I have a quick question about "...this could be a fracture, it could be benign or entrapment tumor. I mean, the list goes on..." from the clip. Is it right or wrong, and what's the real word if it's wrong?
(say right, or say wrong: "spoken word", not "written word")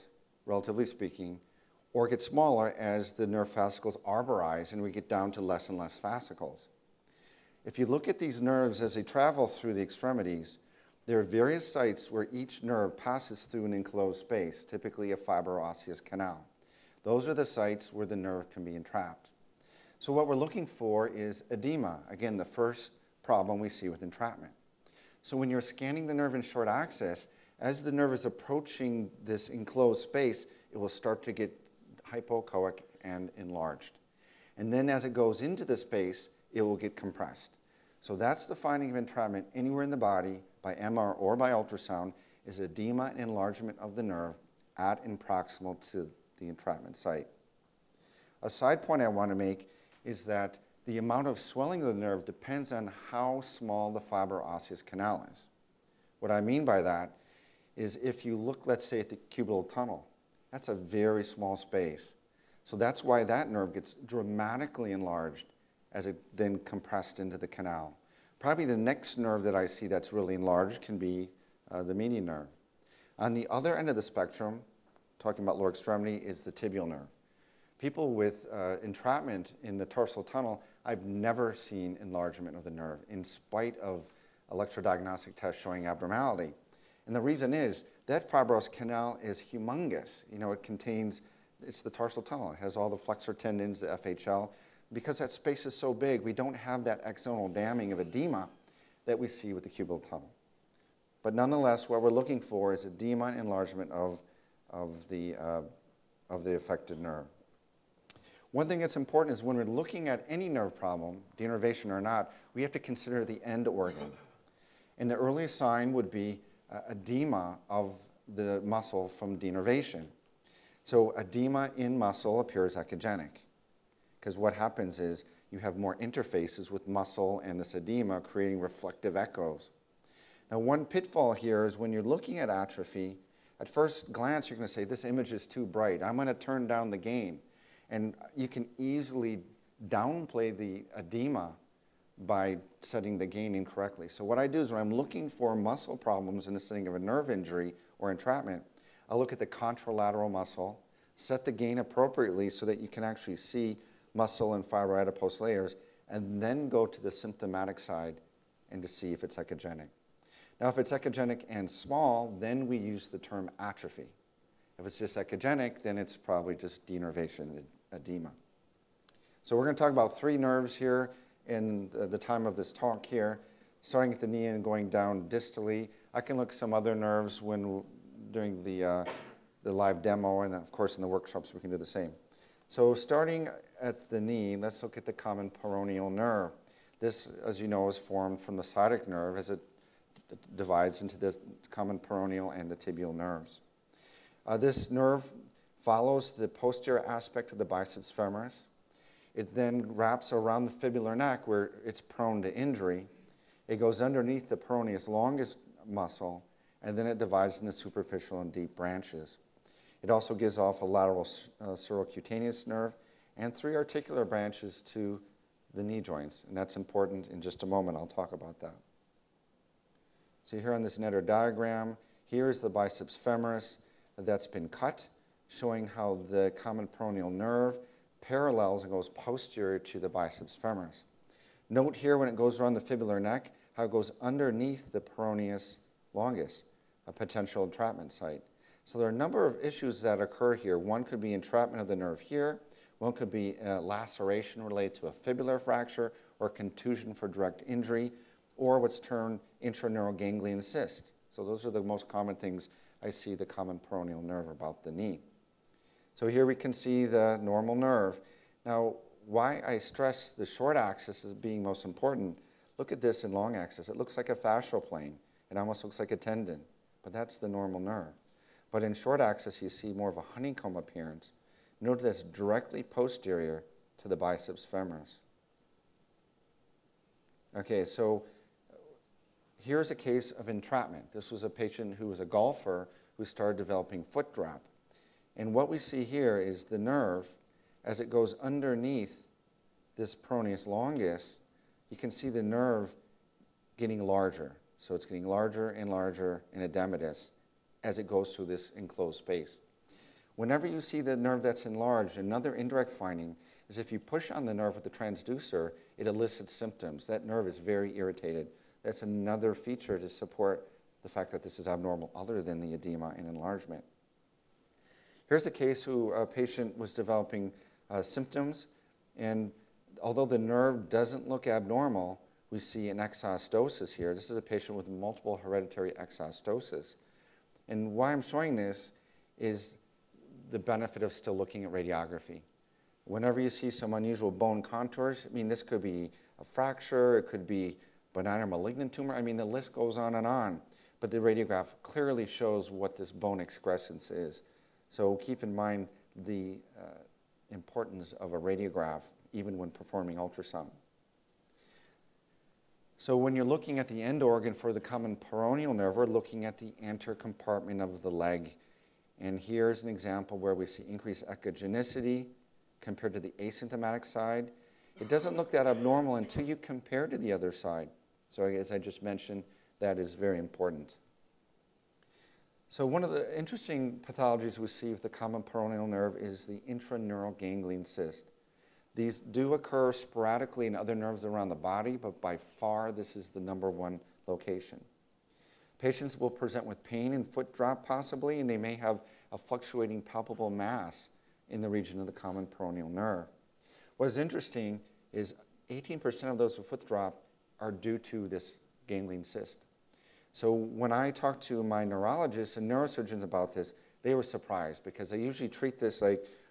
wrong: "malignant", not "entrapment".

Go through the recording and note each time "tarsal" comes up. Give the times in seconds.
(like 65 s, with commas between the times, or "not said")
79 s, 91 s.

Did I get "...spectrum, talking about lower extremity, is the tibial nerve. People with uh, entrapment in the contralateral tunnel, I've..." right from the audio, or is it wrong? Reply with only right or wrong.
wrong.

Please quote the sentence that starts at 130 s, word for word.
Now, one pitfall here is when you're looking at atrophy, at first glance, you're going to say, This image is too bright.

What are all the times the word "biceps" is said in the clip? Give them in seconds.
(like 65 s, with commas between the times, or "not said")
197 s, 222 s, 230 s, 274 s.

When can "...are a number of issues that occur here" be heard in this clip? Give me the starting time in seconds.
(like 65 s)
239 s.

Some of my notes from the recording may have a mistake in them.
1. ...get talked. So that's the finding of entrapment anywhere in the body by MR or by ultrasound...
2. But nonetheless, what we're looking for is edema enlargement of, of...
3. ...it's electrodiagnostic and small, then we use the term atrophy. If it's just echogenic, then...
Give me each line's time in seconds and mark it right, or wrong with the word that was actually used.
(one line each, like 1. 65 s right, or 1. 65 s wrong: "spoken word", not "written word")
1. 36 s wrong: "compressed", not "talked"
2. 101 s right
3. 160 s wrong: "echogenic", not "electrodiagnostic".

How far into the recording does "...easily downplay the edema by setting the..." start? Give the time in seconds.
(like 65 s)
138 s.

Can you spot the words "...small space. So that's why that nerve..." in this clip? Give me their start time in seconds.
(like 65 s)
61 s.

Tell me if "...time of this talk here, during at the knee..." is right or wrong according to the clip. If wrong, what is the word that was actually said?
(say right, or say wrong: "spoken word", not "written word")
wrong: "starting", not "during".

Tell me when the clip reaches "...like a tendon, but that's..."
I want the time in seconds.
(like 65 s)
265 s.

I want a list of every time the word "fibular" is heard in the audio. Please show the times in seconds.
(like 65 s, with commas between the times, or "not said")
200 s, 232 s, 245 s.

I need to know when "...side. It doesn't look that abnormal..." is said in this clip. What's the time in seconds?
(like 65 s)
364 s.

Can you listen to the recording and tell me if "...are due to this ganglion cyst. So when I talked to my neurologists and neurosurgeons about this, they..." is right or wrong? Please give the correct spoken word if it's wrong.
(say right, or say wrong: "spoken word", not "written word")
right.